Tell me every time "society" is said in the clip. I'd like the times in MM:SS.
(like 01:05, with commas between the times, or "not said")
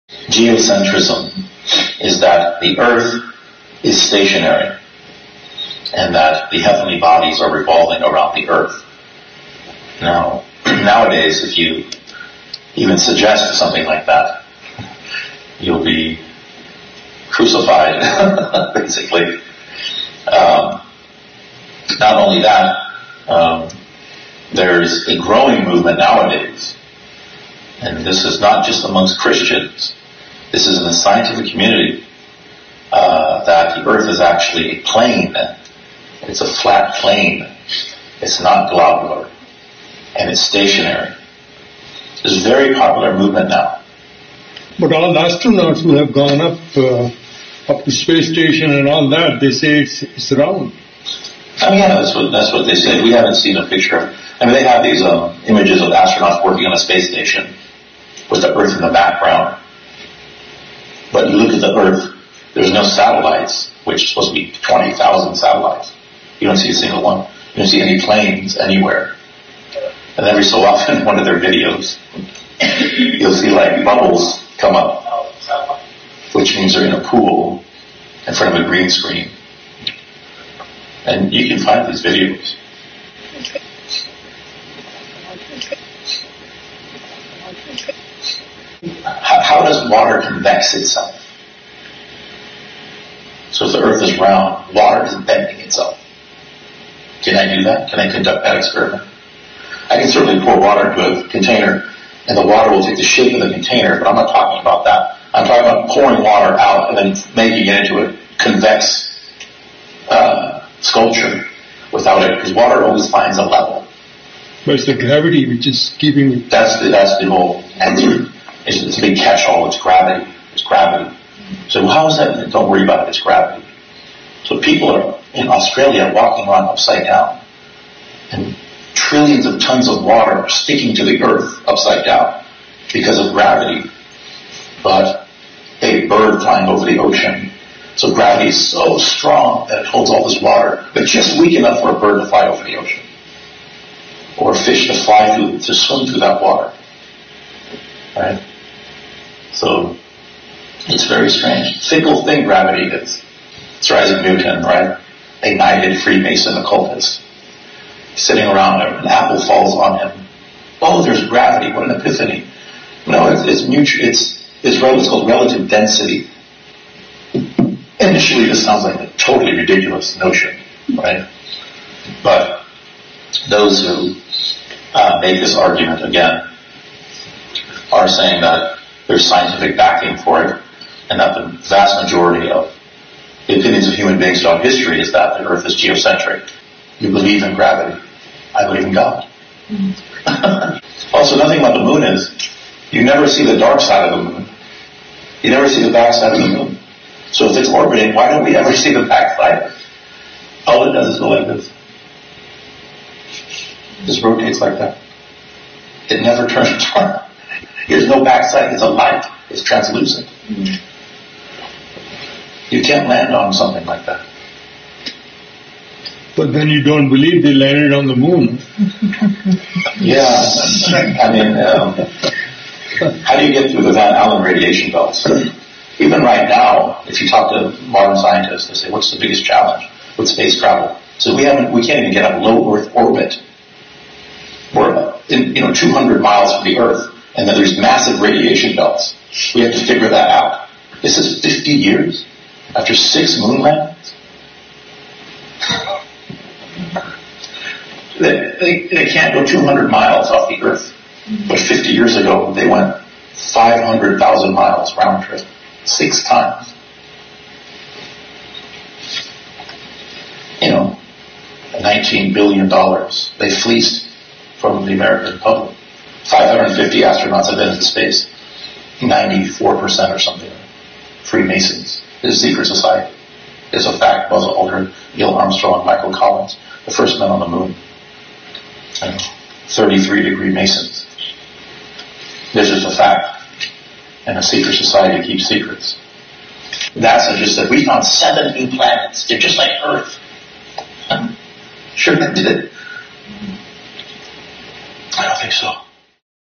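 04:32, 04:44.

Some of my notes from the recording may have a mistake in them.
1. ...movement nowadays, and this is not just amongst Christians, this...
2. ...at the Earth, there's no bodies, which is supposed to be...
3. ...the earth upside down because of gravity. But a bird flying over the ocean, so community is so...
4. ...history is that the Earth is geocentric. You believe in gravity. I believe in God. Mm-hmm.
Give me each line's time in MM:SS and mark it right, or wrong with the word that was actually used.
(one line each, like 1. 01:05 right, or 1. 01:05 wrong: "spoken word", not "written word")
1. 00:25 right
2. 01:01 wrong: "satellites", not "bodies"
3. 02:11 wrong: "gravity", not "community"
4. 03:04 right.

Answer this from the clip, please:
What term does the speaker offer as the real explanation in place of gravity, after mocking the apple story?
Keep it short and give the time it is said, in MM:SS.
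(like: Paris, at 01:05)
relative density, at 02:45.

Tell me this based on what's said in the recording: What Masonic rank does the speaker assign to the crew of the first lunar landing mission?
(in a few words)
33 degree.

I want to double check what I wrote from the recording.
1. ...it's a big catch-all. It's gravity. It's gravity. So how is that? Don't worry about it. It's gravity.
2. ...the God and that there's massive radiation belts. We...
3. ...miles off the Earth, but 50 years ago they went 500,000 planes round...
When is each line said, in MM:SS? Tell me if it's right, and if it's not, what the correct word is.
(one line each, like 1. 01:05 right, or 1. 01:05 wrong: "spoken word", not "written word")
1. 01:58 right
2. 03:56 wrong: "Earth", not "God"
3. 04:09 wrong: "miles", not "planes".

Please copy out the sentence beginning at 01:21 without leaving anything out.
And you can find these videos.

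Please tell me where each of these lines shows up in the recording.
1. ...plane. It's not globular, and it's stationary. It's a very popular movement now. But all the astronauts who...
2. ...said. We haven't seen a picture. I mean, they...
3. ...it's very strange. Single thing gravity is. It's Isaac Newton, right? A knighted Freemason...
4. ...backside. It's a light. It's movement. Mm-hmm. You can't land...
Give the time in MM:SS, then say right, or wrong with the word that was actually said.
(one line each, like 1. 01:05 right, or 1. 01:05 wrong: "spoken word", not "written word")
1. 00:36 right
2. 00:52 right
3. 02:30 right
4. 03:28 wrong: "translucent", not "movement".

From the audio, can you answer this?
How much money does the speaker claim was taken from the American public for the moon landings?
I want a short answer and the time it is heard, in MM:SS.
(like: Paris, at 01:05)
$19 billion, at 04:21.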